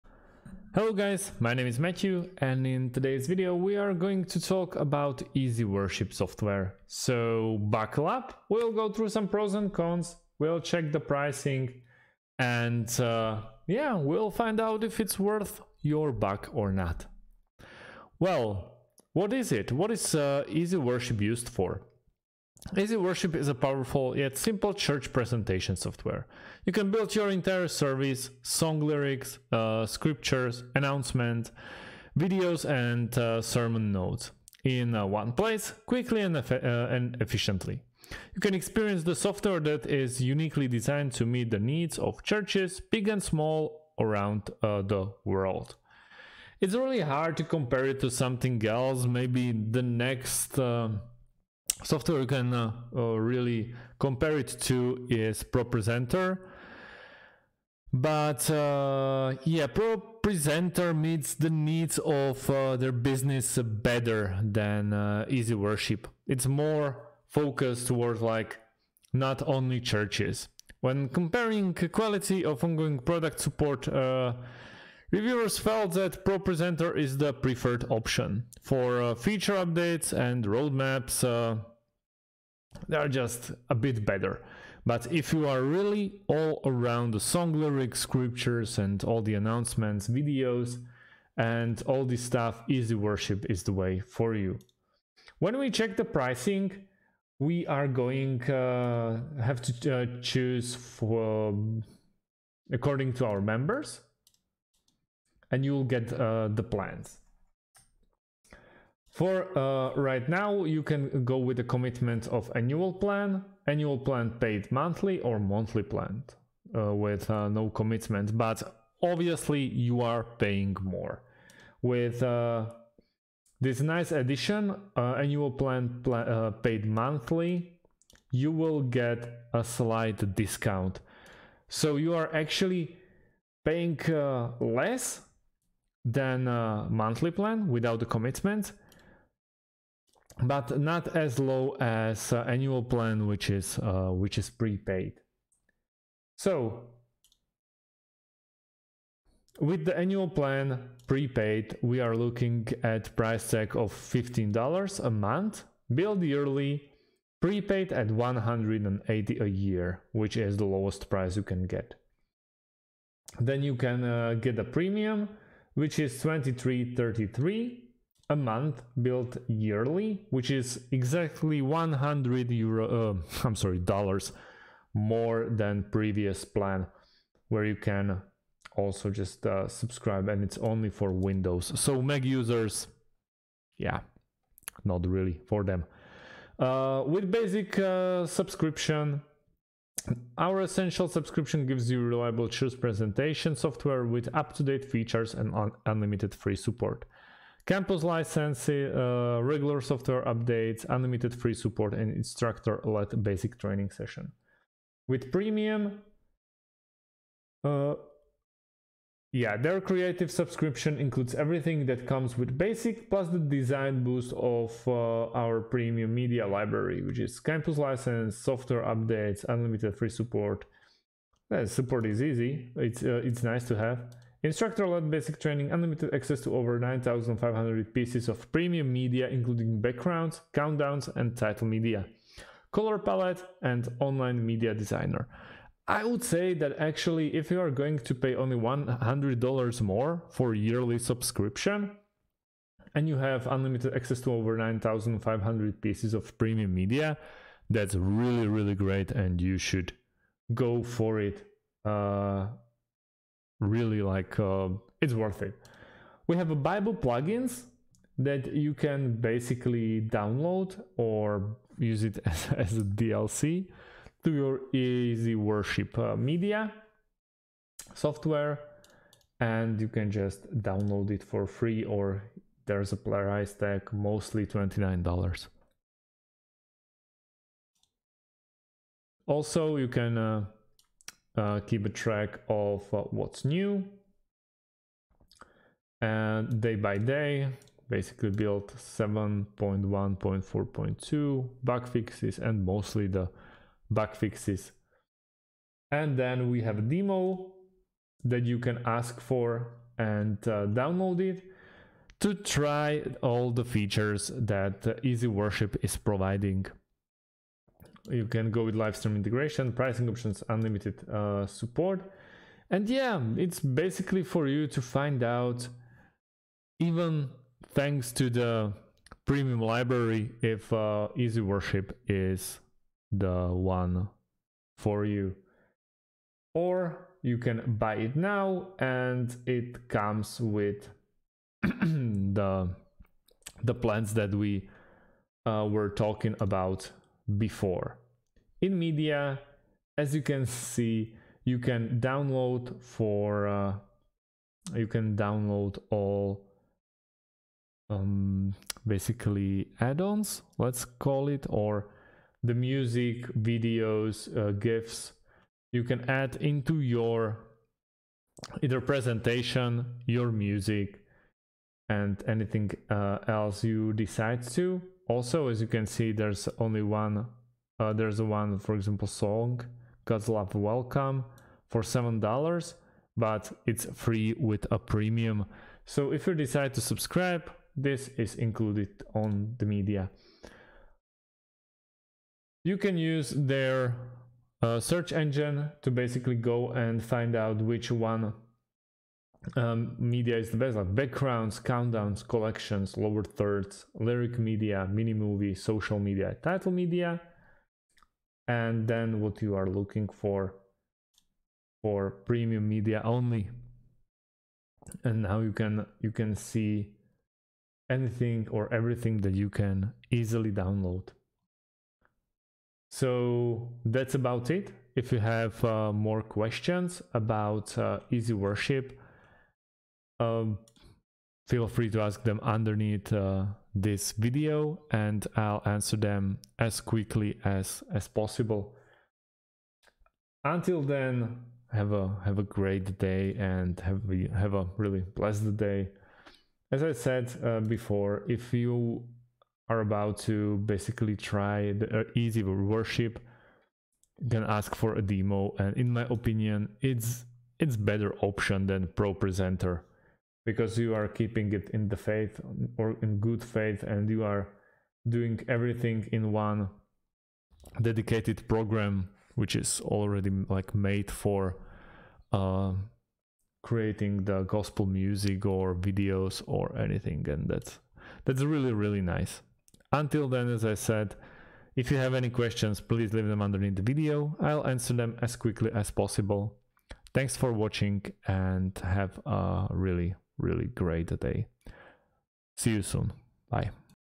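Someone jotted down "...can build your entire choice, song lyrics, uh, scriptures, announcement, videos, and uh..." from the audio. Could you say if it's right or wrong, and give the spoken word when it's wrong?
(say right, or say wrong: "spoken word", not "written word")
wrong: "service", not "choice".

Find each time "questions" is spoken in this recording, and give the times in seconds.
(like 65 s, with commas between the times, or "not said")
416 s, 472 s.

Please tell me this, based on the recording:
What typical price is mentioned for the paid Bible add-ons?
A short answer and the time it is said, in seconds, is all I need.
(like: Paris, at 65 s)
$29, at 274 s.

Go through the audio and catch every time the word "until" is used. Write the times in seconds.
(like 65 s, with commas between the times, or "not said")
430 s, 469 s.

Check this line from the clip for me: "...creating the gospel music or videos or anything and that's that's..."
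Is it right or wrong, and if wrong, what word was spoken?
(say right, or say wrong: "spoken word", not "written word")
right.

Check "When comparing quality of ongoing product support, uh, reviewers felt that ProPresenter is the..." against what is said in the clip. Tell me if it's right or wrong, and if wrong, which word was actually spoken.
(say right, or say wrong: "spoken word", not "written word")
right.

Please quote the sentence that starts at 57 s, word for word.
But uh, yeah, ProPresenter meets the needs of their business better than uh, EasyWorship.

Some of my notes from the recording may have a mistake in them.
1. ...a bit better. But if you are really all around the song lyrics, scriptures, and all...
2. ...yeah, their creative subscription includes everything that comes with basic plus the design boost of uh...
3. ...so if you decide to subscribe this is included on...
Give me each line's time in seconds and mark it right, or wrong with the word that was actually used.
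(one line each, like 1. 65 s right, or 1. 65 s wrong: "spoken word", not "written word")
1. 83 s right
2. 209 s right
3. 375 s right.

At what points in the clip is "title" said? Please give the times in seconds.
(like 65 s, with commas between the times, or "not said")
231 s, 396 s.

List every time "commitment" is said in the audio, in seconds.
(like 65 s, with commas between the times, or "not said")
111 s, 117 s, 138 s.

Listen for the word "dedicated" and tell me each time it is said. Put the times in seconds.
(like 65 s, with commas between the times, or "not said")
457 s.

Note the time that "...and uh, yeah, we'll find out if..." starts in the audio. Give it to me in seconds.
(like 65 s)
12 s.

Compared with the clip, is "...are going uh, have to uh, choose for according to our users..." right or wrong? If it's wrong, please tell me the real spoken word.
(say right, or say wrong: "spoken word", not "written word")
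wrong: "members", not "users".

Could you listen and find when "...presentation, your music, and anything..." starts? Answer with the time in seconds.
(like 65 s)
358 s.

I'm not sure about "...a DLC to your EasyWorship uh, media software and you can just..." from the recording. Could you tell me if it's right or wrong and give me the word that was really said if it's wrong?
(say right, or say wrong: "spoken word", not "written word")
right.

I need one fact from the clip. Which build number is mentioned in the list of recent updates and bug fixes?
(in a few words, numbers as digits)
7.1.4.2.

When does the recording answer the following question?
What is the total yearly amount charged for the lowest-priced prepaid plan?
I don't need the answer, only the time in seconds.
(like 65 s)
158 s.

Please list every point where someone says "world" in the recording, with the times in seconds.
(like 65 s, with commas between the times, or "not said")
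45 s.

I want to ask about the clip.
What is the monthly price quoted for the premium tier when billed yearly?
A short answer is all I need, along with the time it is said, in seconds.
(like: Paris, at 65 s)
$23.33, at 166 s.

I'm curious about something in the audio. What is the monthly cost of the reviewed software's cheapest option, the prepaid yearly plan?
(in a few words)
$15.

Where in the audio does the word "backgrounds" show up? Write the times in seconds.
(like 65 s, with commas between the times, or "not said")
229 s, 390 s.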